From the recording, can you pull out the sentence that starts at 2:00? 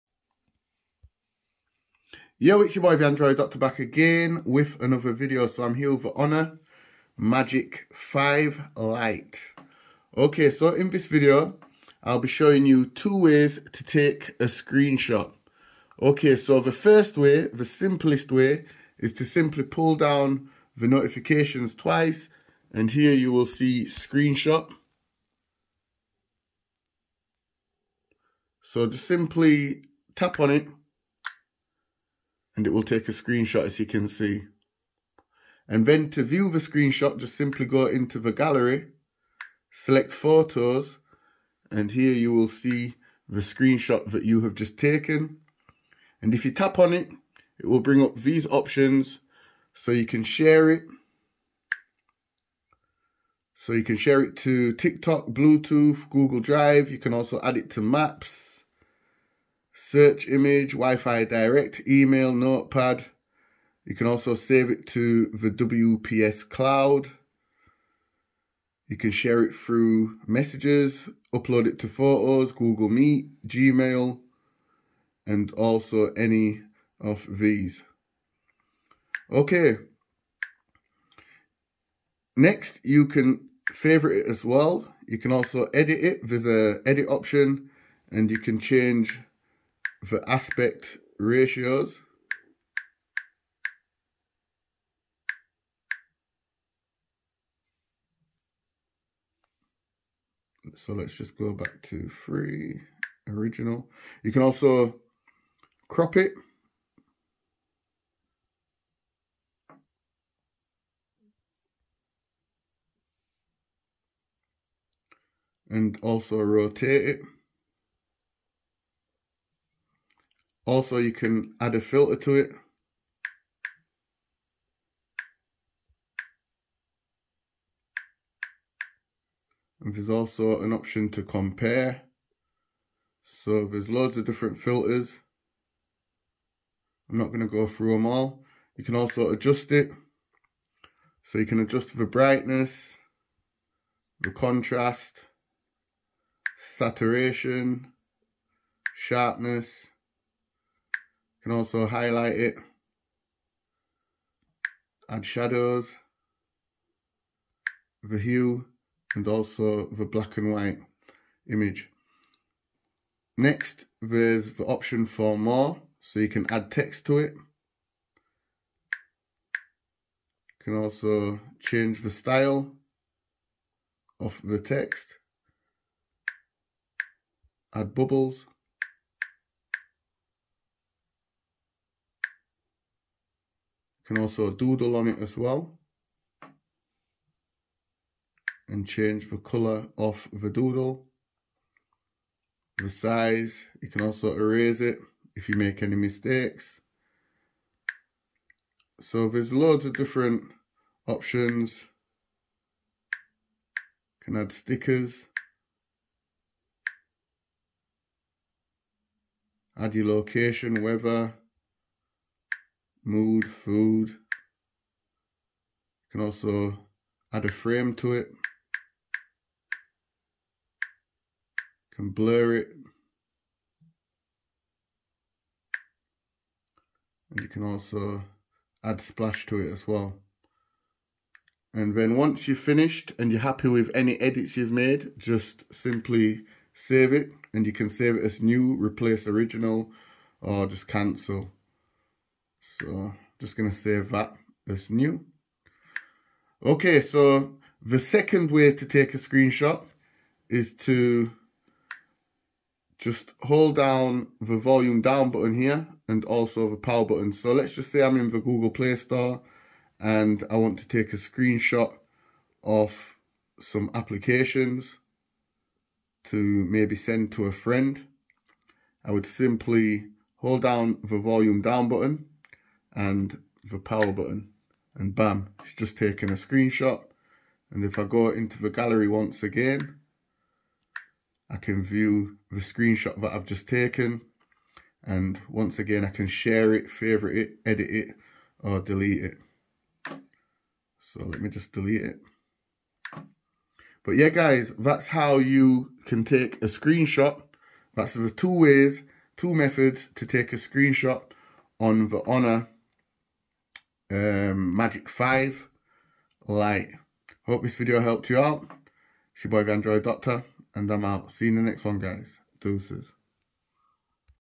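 Also, you can add a filter to it.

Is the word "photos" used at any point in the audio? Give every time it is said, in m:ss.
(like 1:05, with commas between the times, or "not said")
0:40, 1:11.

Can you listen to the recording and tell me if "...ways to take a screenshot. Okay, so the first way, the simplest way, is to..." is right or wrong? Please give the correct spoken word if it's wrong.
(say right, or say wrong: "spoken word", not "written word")
right.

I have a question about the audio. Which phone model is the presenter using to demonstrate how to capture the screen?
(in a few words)
Honor Magic 5 Lite.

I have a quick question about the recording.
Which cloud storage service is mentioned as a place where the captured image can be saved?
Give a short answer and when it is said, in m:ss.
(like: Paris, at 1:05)
WPS cloud, at 1:05.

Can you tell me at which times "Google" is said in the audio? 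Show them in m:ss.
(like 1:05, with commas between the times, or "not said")
0:56, 1:12, 4:18.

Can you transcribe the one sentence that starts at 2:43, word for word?
Next, there's the option for more, so you can add text to it.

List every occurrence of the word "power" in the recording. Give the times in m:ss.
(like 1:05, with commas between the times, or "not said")
4:16, 4:33.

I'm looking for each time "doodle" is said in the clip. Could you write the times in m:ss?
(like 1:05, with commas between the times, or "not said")
3:04, 3:10.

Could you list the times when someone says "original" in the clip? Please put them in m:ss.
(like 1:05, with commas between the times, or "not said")
1:43, 3:59.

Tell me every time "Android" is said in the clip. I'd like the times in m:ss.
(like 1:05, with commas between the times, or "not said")
0:03, 5:09.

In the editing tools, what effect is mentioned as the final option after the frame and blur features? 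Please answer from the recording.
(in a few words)
splash.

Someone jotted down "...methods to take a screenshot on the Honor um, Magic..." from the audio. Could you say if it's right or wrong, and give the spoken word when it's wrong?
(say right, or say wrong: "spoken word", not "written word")
right.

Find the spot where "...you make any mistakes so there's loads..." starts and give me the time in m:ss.
3:15.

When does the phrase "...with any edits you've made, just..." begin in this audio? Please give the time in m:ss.
3:53.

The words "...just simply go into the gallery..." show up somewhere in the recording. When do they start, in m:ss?
0:37.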